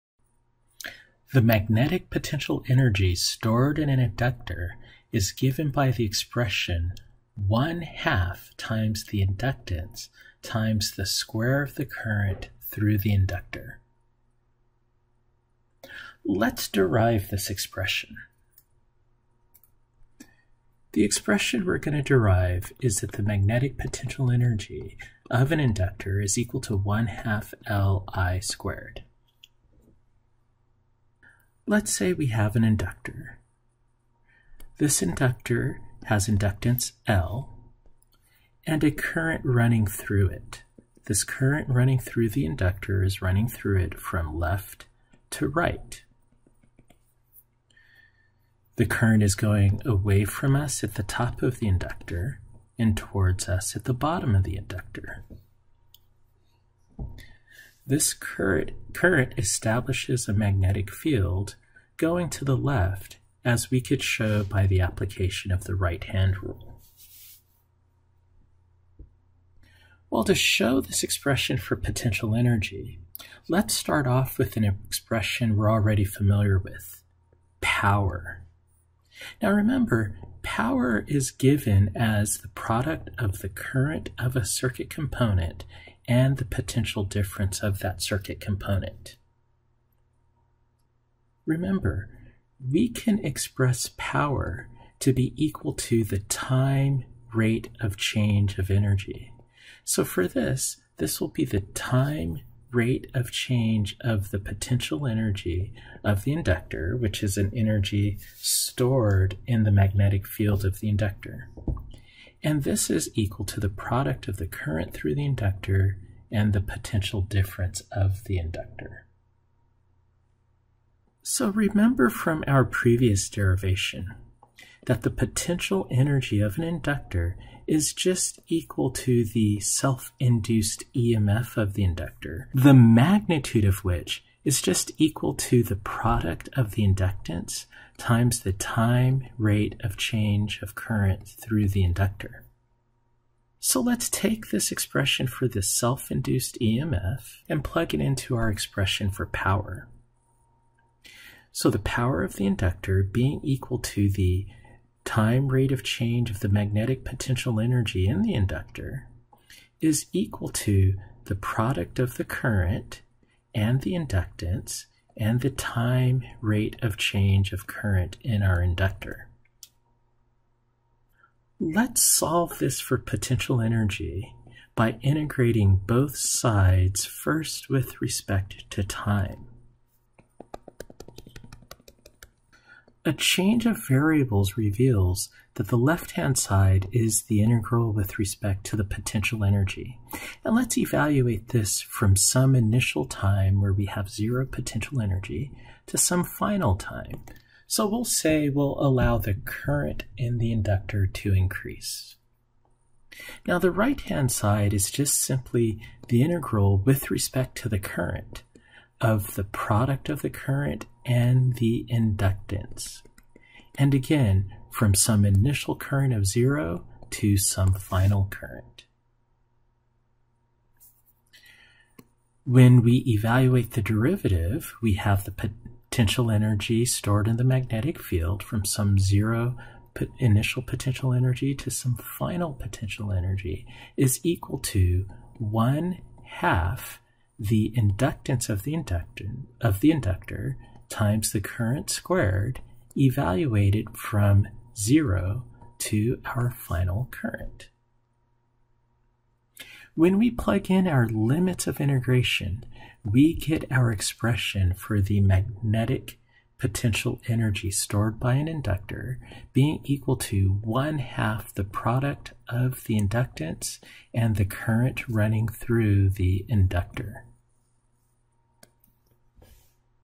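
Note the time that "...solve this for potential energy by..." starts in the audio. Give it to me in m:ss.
2:52.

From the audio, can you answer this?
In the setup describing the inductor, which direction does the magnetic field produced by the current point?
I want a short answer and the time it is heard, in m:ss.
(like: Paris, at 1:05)
To the left, at 1:01.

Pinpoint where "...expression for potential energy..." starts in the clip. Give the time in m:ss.
1:11.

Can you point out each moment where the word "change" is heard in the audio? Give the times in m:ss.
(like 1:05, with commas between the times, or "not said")
1:37, 1:43, 2:19, 2:35, 2:46, 3:03.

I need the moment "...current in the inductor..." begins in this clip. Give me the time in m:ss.
3:19.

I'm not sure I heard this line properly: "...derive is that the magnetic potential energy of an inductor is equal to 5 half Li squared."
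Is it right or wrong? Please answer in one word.
wrong.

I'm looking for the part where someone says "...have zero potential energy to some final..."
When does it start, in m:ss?
3:13.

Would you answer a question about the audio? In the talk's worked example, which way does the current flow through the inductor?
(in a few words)
Left to right.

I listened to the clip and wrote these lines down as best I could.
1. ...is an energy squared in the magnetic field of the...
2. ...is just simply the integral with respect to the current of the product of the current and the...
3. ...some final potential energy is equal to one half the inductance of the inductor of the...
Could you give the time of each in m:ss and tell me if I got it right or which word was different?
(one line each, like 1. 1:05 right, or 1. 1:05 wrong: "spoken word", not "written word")
1. 1:47 wrong: "stored", not "squared"
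2. 3:24 right
3. 3:51 right.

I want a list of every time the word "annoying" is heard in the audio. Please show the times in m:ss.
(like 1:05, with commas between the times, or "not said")
not said.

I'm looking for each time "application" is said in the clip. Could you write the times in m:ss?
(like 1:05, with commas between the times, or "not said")
1:04.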